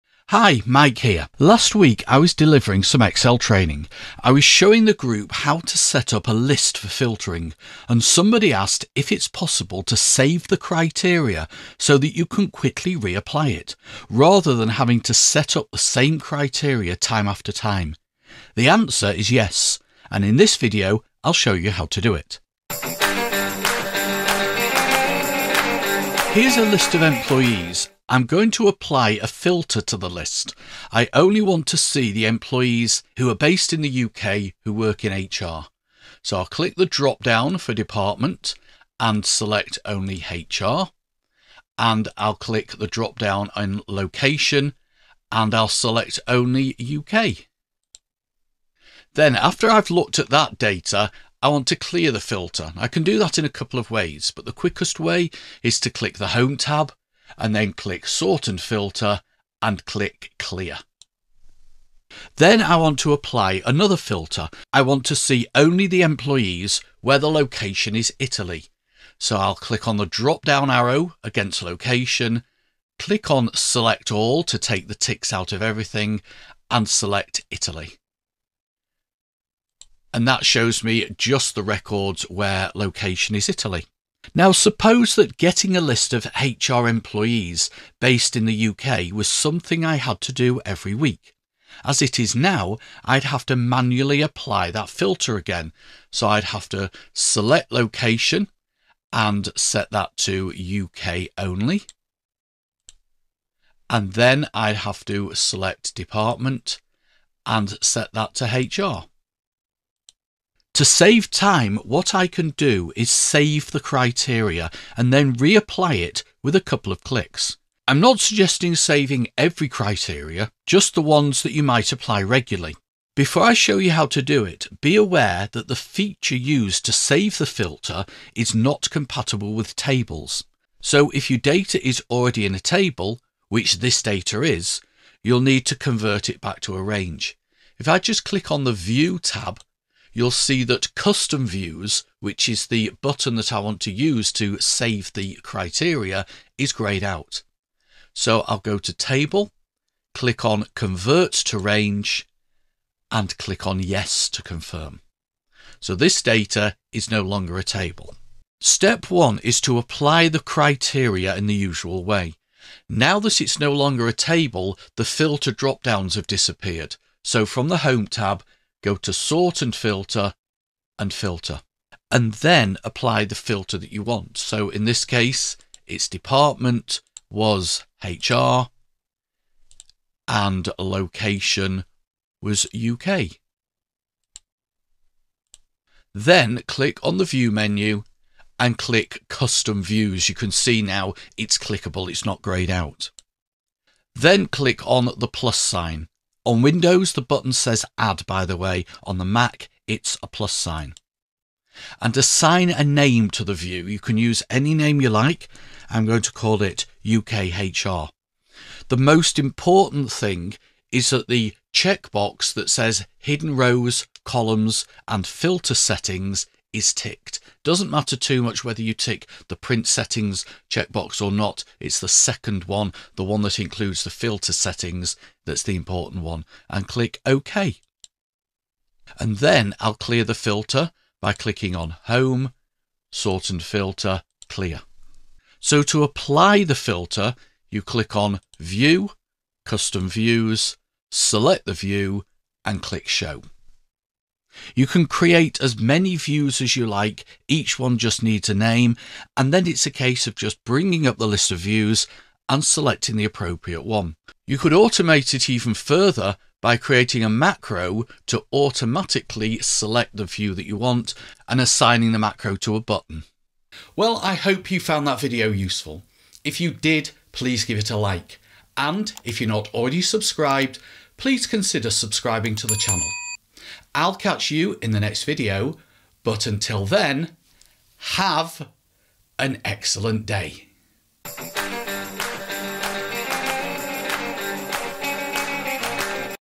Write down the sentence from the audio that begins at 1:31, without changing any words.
As it is now, I'd have to manually apply that filter again.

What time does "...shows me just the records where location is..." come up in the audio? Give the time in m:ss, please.
1:20.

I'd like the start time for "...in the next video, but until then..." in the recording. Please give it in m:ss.
4:34.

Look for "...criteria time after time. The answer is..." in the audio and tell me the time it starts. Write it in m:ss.
0:16.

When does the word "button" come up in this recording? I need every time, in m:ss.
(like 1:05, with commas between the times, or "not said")
2:23, 3:17, 4:22.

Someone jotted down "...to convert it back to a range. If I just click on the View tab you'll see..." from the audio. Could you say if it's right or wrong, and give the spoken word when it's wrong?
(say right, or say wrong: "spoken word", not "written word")
right.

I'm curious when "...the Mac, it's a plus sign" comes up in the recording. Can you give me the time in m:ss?
3:19.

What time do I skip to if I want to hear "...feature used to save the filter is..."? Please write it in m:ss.
2:05.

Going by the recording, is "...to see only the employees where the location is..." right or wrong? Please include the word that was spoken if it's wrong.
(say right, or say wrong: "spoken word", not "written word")
right.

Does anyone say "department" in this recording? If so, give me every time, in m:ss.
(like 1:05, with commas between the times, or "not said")
0:37, 1:45, 2:56.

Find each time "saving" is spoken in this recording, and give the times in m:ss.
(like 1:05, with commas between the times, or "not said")
1:58.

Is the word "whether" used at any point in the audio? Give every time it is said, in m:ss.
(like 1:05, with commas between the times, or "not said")
3:38.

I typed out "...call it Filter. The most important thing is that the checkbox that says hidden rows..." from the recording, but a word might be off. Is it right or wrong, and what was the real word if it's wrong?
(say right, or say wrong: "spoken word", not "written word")
wrong: "UKHR", not "Filter".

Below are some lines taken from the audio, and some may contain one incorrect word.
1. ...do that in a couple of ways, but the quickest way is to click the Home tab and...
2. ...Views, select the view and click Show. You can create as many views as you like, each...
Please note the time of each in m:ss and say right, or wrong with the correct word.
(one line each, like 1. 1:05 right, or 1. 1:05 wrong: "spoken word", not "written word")
1. 0:53 right
2. 4:00 right.